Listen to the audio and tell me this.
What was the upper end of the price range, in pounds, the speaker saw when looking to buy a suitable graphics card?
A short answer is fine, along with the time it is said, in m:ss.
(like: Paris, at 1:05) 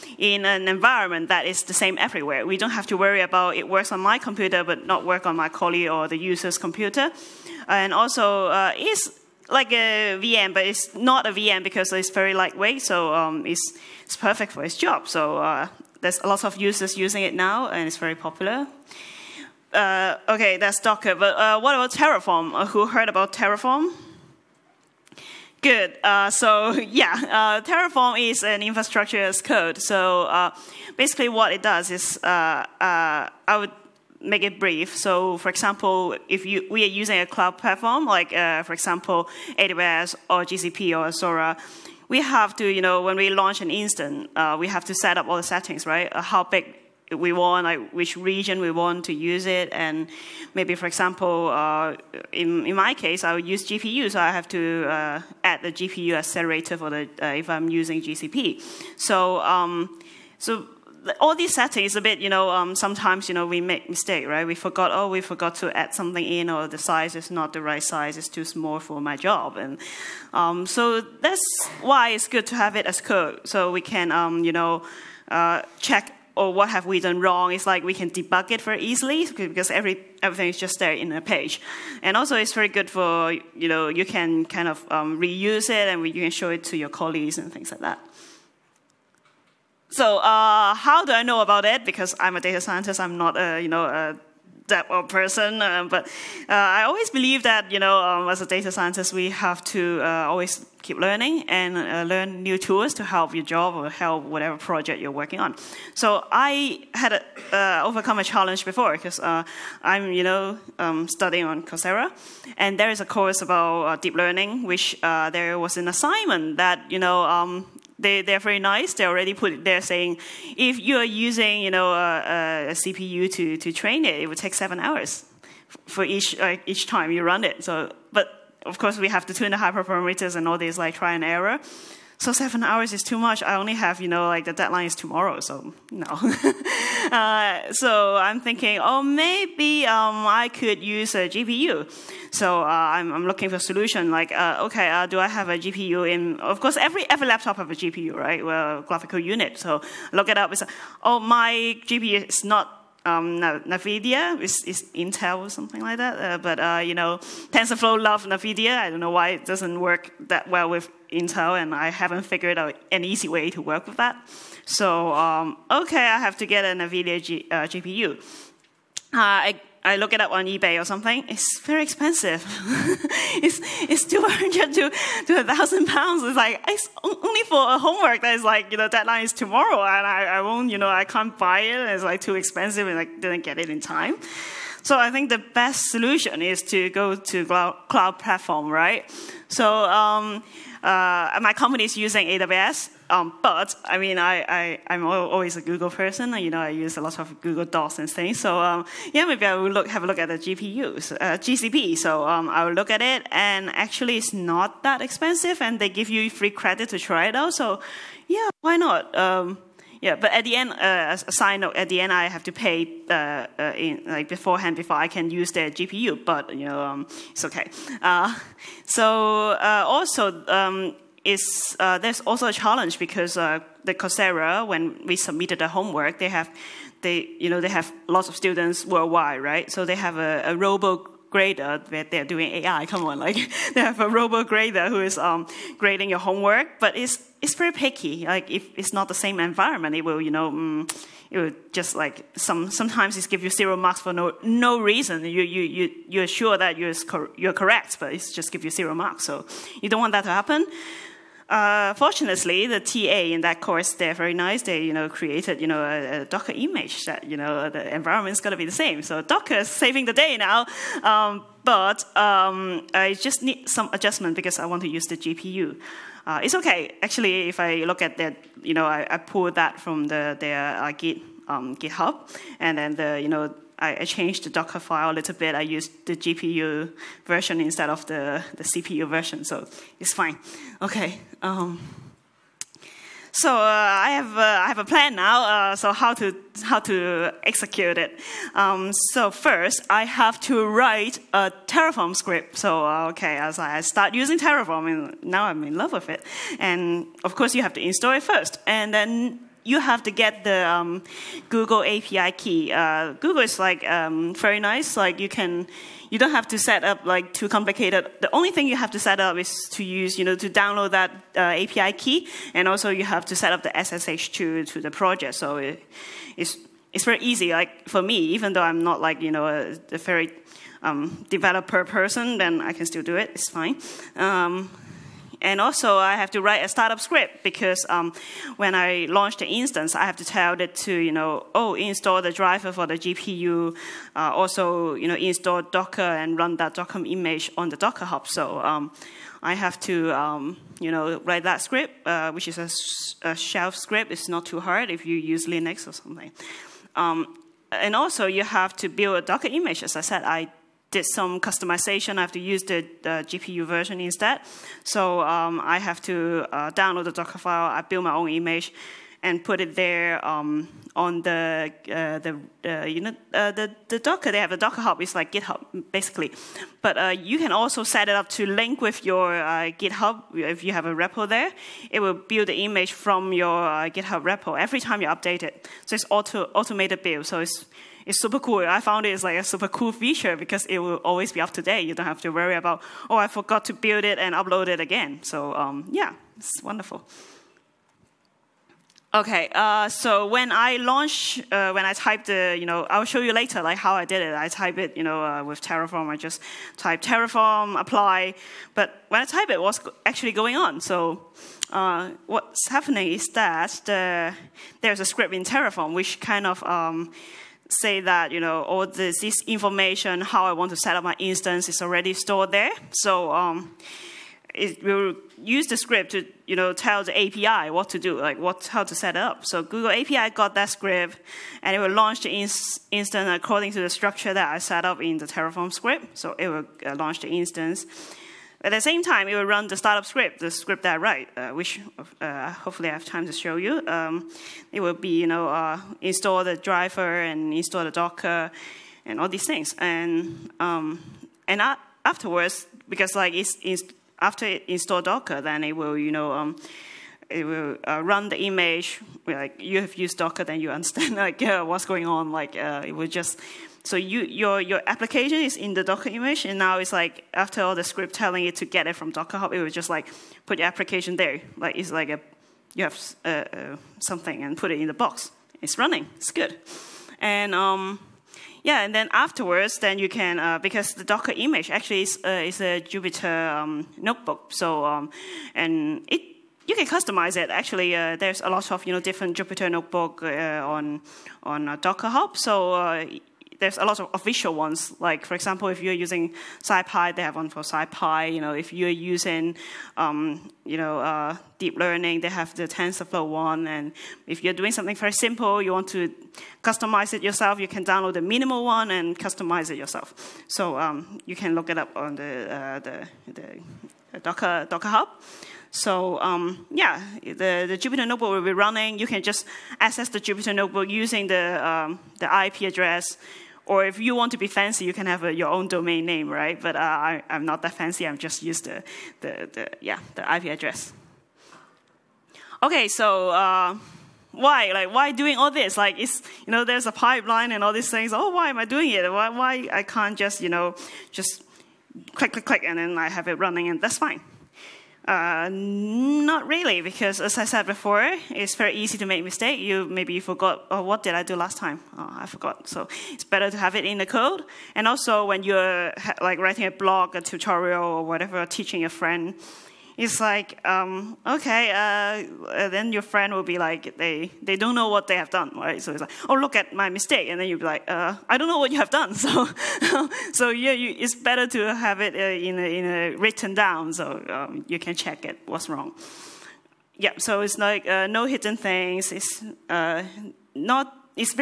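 1000 pounds, at 2:55.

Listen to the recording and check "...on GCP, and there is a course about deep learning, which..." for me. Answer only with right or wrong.
wrong.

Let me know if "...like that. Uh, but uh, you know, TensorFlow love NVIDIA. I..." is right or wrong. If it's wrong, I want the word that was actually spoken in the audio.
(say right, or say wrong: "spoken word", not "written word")
right.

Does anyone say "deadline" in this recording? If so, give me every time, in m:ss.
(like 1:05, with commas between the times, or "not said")
2:14, 2:58.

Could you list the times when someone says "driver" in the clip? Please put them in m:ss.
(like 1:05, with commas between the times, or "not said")
5:32, 7:16.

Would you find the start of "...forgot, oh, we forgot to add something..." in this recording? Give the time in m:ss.
1:04.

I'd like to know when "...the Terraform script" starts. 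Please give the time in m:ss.
7:05.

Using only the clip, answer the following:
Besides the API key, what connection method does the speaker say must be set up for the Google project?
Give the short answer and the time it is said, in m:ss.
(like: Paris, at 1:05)
SSH, at 5:13.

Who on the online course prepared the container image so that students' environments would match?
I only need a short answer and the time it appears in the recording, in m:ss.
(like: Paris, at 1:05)
The TA, at 4:12.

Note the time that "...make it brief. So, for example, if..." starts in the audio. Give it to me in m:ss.
0:34.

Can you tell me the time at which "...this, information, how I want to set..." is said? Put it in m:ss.
6:49.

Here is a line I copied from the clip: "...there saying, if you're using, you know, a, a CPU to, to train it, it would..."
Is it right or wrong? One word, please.
right.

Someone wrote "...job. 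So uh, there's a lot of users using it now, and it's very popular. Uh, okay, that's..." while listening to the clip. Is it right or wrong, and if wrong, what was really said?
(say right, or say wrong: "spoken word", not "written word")
right.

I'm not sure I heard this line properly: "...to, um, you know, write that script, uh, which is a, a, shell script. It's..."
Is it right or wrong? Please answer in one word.
right.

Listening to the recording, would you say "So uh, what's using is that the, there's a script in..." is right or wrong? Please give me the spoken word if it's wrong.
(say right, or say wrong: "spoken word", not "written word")
wrong: "happening", not "using".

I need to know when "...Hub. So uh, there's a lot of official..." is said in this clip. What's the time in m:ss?
8:02.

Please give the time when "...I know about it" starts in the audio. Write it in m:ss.
1:31.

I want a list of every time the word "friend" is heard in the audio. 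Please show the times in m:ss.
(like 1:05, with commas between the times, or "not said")
9:08, 9:13.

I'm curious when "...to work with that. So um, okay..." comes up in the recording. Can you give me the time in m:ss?
2:43.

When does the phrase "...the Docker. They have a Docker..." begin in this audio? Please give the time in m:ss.
6:03.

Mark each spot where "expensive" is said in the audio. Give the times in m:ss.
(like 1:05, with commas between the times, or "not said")
2:51, 3:02, 3:25.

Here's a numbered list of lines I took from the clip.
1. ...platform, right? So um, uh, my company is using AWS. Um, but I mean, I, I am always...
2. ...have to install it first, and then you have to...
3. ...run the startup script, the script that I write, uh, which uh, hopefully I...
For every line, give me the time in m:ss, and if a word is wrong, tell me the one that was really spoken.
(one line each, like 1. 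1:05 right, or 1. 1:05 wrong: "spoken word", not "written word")
1. 3:08 right
2. 4:57 right
3. 7:09 right.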